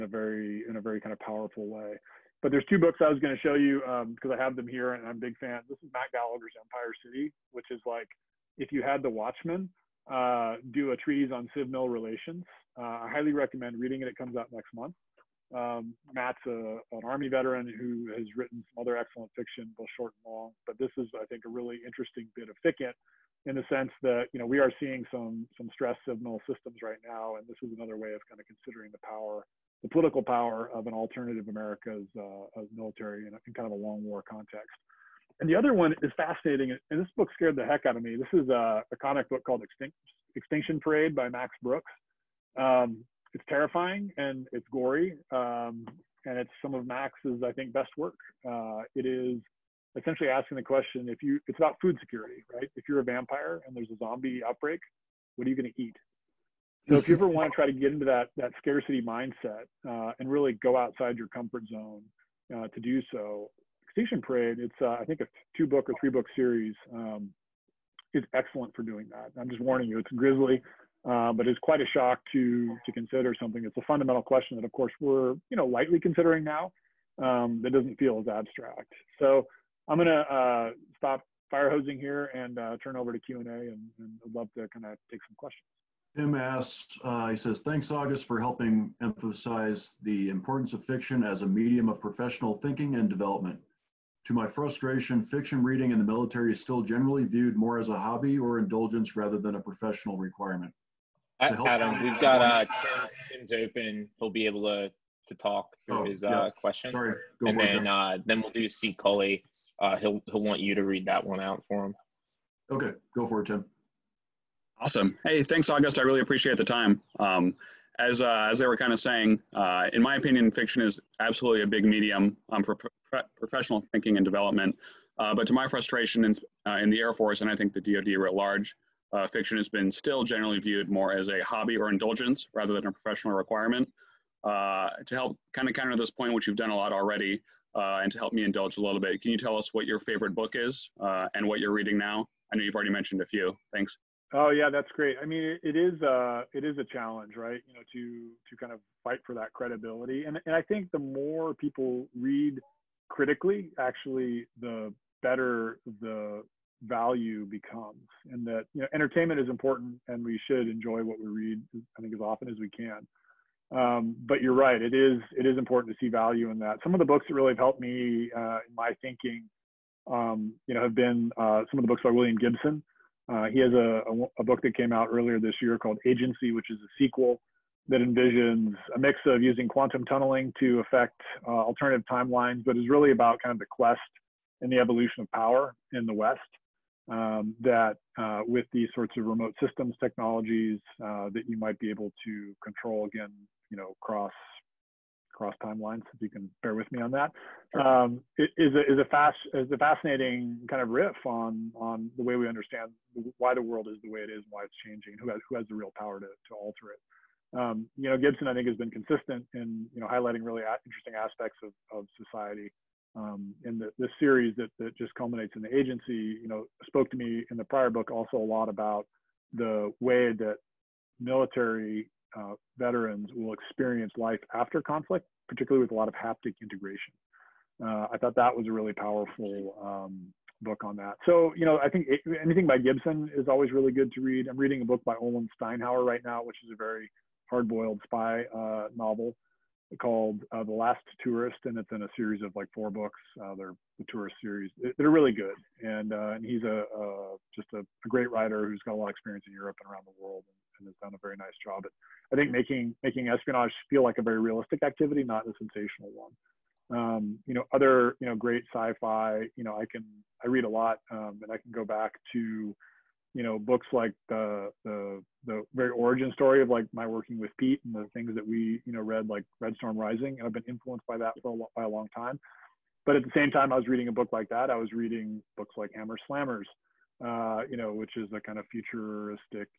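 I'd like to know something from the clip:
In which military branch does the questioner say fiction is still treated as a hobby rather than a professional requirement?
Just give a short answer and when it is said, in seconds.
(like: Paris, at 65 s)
Air Force, at 126 s.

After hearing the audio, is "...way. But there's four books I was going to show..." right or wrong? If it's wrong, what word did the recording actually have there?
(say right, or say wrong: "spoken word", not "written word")
wrong: "two", not "four".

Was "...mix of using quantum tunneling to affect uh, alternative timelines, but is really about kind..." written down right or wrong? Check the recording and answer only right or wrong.
right.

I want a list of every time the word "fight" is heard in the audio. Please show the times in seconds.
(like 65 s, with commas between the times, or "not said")
149 s.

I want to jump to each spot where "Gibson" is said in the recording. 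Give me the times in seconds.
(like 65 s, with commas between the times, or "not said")
172 s, 208 s, 232 s.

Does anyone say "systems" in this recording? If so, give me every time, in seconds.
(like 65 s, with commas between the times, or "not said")
26 s, 189 s.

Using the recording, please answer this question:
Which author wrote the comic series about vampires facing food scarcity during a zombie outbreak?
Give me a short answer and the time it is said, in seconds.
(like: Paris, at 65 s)
Max Brooks, at 41 s.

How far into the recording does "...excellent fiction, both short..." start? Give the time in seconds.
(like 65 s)
18 s.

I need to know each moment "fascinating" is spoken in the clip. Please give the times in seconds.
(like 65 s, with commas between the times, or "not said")
36 s, 199 s.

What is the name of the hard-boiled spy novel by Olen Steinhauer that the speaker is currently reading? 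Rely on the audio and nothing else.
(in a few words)
The Last Tourist.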